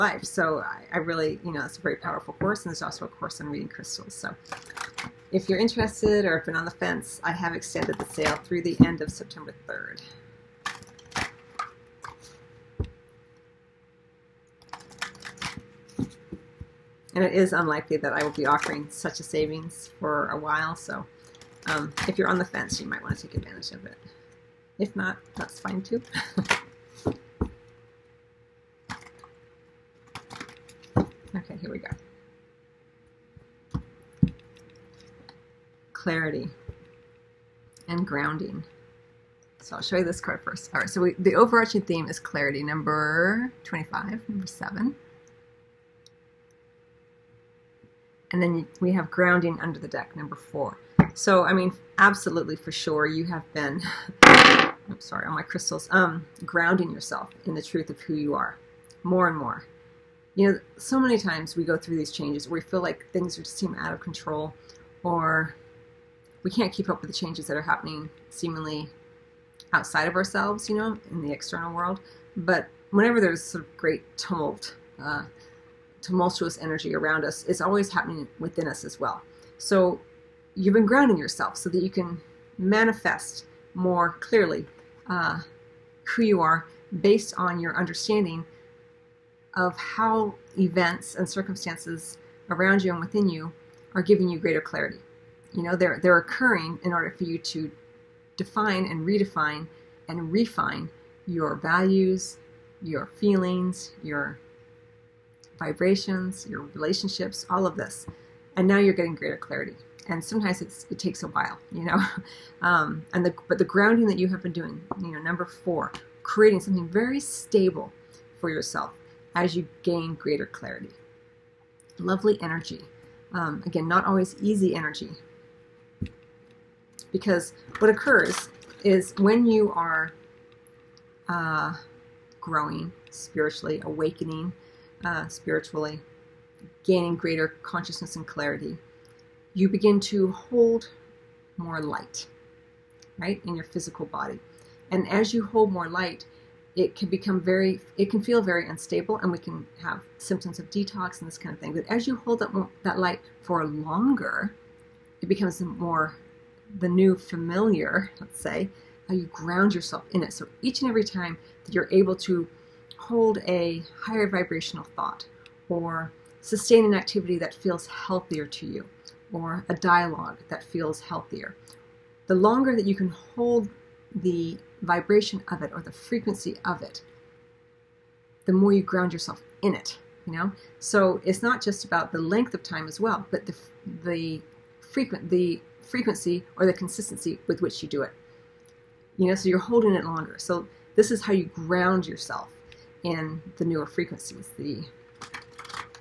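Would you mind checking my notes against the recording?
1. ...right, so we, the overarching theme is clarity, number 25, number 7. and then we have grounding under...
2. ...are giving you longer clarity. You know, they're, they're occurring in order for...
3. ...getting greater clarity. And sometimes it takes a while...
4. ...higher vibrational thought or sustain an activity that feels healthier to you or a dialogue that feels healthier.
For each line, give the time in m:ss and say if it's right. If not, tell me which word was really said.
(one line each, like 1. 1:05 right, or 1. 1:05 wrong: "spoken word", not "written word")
1. 0:40 right
2. 1:33 wrong: "greater", not "longer"
3. 1:48 right
4. 2:43 right.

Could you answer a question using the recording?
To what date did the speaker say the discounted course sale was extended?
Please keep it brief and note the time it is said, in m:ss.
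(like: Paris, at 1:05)
September 3rd, at 0:09.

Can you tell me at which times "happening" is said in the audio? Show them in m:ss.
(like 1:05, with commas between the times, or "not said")
1:07, 1:17.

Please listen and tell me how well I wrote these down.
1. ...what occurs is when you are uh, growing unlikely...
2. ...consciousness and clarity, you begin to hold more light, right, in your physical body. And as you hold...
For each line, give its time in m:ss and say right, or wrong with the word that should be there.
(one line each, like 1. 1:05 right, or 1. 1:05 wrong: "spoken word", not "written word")
1. 2:07 wrong: "spiritually", not "unlikely"
2. 2:17 right.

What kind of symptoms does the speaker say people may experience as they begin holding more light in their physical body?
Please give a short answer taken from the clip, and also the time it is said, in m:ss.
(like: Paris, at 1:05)
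Detox, at 2:30.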